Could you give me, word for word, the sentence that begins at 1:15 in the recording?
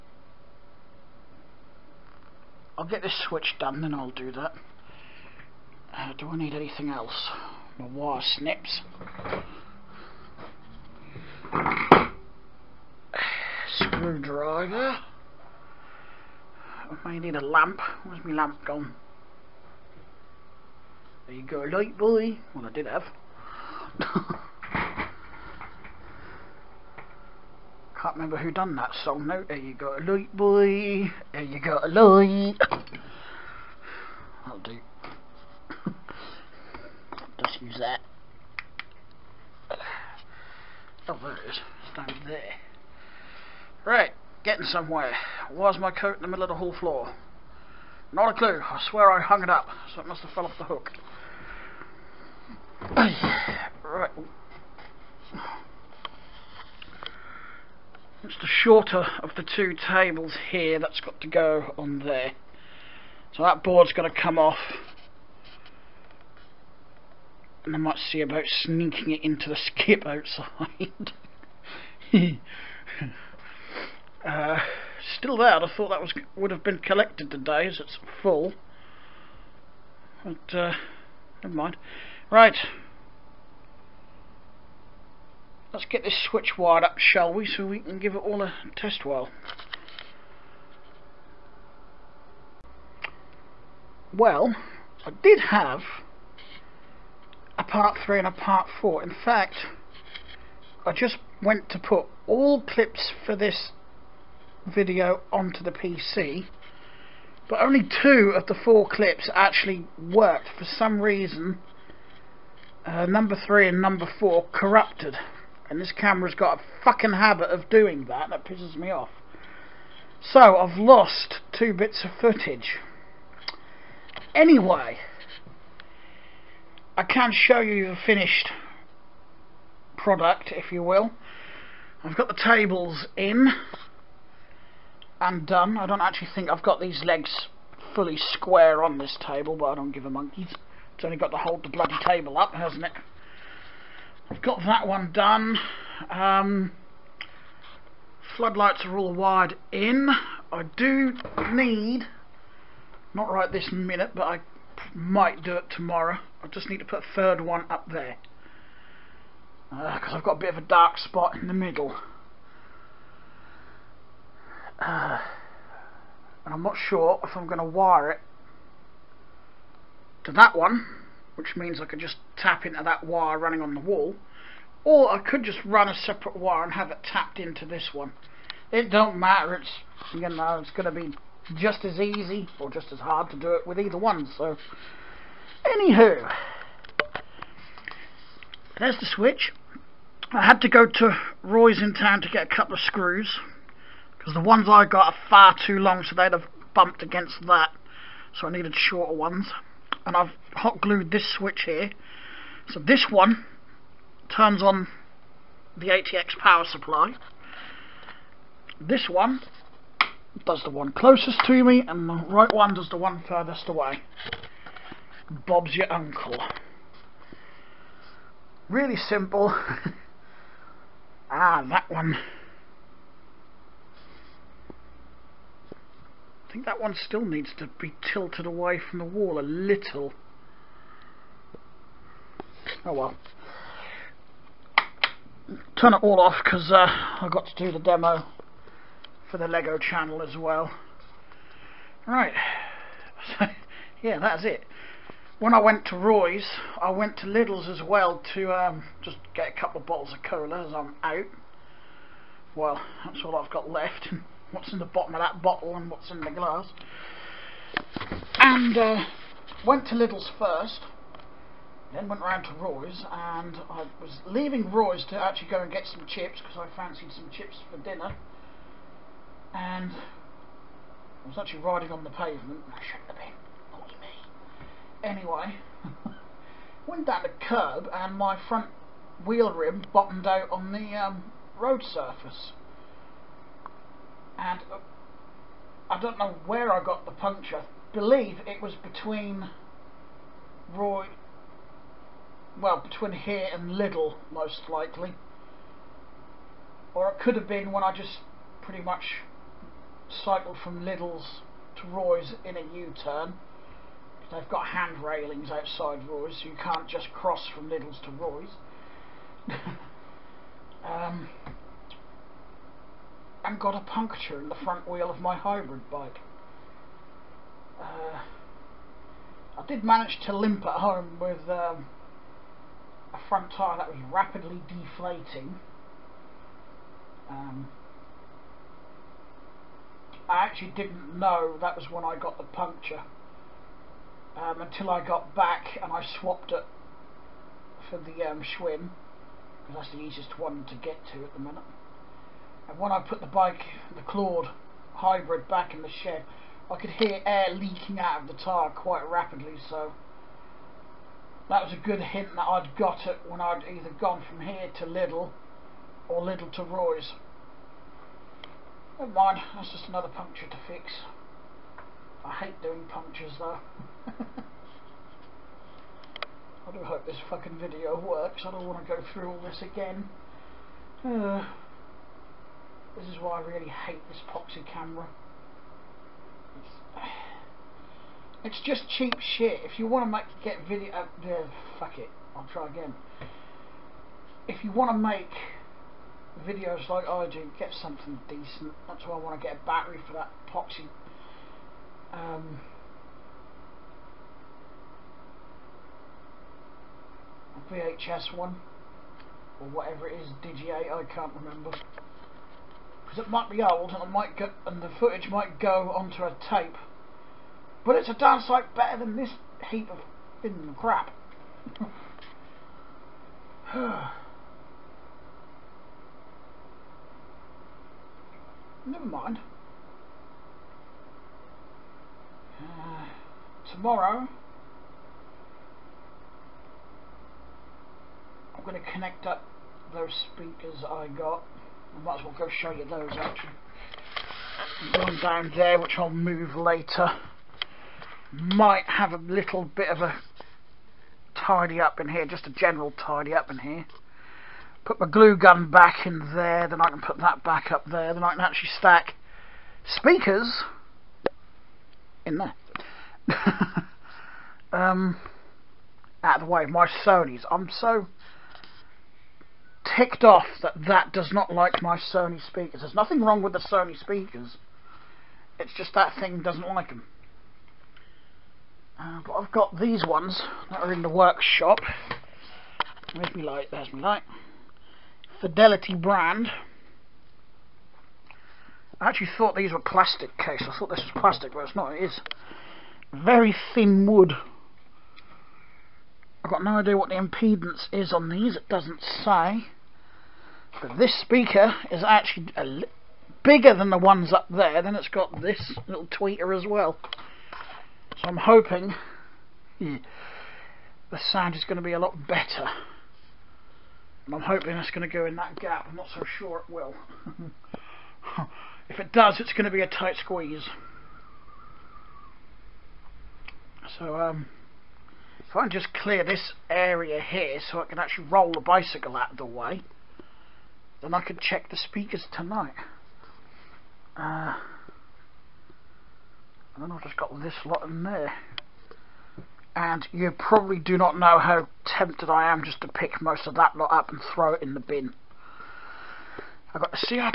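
I thought that was would have been collected today as it's full.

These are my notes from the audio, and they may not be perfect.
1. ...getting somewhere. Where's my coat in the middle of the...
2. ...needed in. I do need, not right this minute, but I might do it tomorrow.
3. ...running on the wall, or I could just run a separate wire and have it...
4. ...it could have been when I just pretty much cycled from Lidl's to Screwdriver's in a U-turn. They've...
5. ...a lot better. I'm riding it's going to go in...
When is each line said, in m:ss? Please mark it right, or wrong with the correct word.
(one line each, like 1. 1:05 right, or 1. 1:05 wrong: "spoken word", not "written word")
1. 0:44 right
2. 2:29 wrong: "wired", not "needed"
3. 2:53 right
4. 4:57 wrong: "Roy", not "Screwdriver"
5. 8:21 wrong: "hoping", not "riding".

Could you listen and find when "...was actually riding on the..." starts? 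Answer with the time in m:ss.
4:31.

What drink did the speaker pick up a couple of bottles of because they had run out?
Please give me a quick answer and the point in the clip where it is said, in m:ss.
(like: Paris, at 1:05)
Cola, at 4:10.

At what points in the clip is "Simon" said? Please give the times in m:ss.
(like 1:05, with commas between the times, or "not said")
not said.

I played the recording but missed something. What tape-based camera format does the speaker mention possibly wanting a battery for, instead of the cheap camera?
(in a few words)
Digi8.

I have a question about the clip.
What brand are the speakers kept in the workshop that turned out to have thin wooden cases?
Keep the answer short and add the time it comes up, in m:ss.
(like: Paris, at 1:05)
Fidelity, at 7:55.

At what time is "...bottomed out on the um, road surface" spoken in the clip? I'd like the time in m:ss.
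4:39.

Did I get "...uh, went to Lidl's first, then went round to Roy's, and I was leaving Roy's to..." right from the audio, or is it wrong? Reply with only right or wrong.
right.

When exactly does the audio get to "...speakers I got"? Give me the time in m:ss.
7:10.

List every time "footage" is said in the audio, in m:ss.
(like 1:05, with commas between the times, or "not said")
2:02, 6:44.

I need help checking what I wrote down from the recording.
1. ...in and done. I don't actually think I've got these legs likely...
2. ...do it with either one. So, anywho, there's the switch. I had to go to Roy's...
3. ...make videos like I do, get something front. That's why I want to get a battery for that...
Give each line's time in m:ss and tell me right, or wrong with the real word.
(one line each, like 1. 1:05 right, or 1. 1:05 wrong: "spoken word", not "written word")
1. 2:13 wrong: "fully", not "likely"
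2. 3:03 right
3. 6:24 wrong: "decent", not "front".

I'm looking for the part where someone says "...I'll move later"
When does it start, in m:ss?
7:15.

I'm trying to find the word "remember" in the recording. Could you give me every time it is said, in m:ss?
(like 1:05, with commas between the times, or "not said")
0:28, 6:41.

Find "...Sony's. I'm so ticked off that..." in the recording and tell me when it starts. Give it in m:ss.
7:37.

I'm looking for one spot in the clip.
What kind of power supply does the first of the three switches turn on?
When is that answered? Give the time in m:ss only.
3:25.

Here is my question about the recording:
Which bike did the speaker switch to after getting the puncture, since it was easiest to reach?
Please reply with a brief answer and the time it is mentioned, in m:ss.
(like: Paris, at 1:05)
Schwinn, at 5:38.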